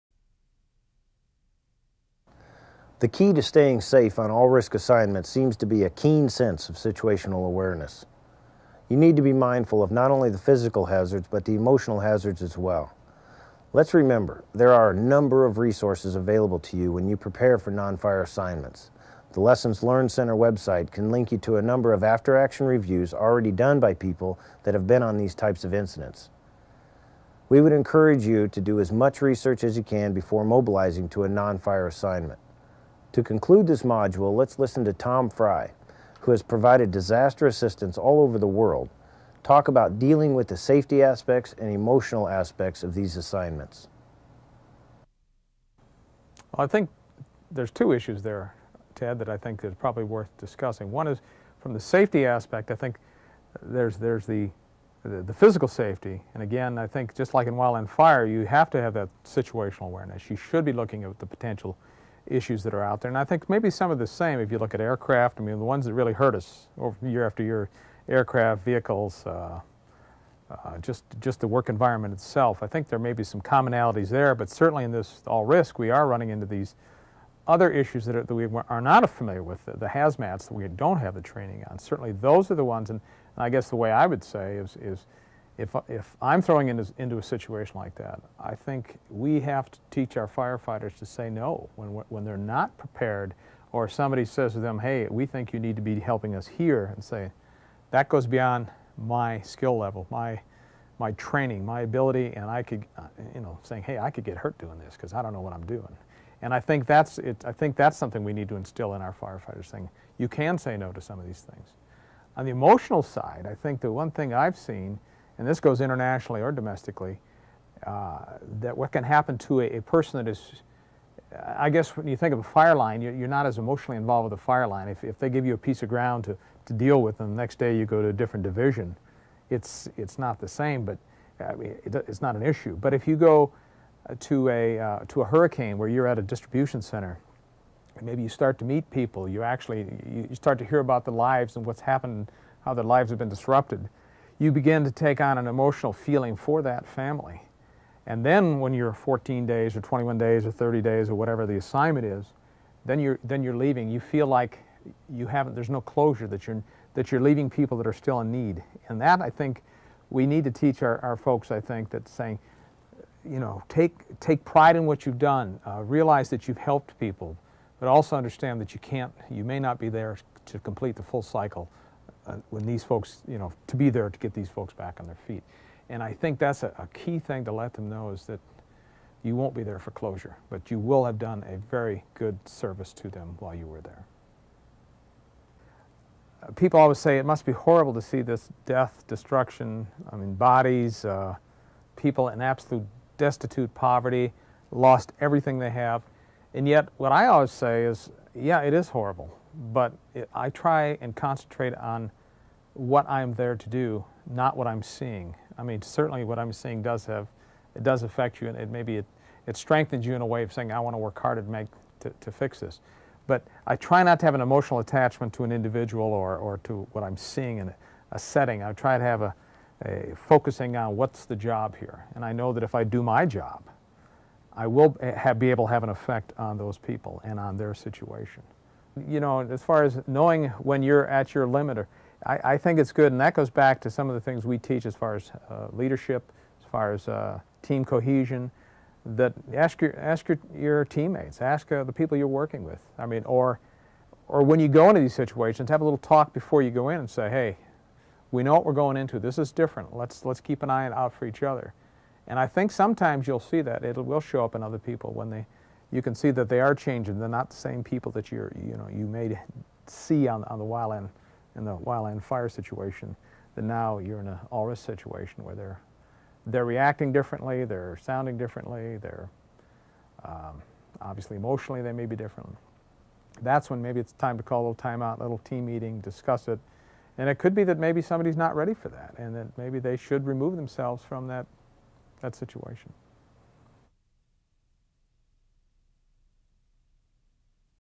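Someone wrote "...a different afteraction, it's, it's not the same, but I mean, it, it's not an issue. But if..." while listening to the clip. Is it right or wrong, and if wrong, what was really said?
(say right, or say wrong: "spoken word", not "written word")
wrong: "division", not "afteraction".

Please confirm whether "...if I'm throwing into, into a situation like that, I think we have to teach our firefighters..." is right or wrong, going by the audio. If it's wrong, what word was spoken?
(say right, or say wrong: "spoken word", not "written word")
right.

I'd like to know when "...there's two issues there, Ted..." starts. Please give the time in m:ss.
0:47.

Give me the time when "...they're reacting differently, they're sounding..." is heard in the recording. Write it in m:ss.
4:26.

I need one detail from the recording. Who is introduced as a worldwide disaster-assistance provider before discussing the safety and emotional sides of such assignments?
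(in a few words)
Tom Fry.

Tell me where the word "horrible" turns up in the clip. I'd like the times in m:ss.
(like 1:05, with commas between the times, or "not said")
3:07, 3:18.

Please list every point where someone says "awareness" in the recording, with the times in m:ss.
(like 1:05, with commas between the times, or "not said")
0:07, 0:59.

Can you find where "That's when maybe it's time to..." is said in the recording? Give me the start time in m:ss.
4:33.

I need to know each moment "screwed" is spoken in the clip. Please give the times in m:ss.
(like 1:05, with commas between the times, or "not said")
not said.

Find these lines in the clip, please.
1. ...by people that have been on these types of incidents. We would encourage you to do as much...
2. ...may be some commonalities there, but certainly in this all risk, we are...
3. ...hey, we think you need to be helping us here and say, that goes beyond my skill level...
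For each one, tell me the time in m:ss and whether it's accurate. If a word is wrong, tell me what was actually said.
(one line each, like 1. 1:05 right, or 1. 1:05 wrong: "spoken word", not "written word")
1. 0:23 right
2. 1:12 right
3. 1:34 right.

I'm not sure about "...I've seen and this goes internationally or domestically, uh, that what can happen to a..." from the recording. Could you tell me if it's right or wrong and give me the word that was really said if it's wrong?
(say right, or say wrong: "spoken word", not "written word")
right.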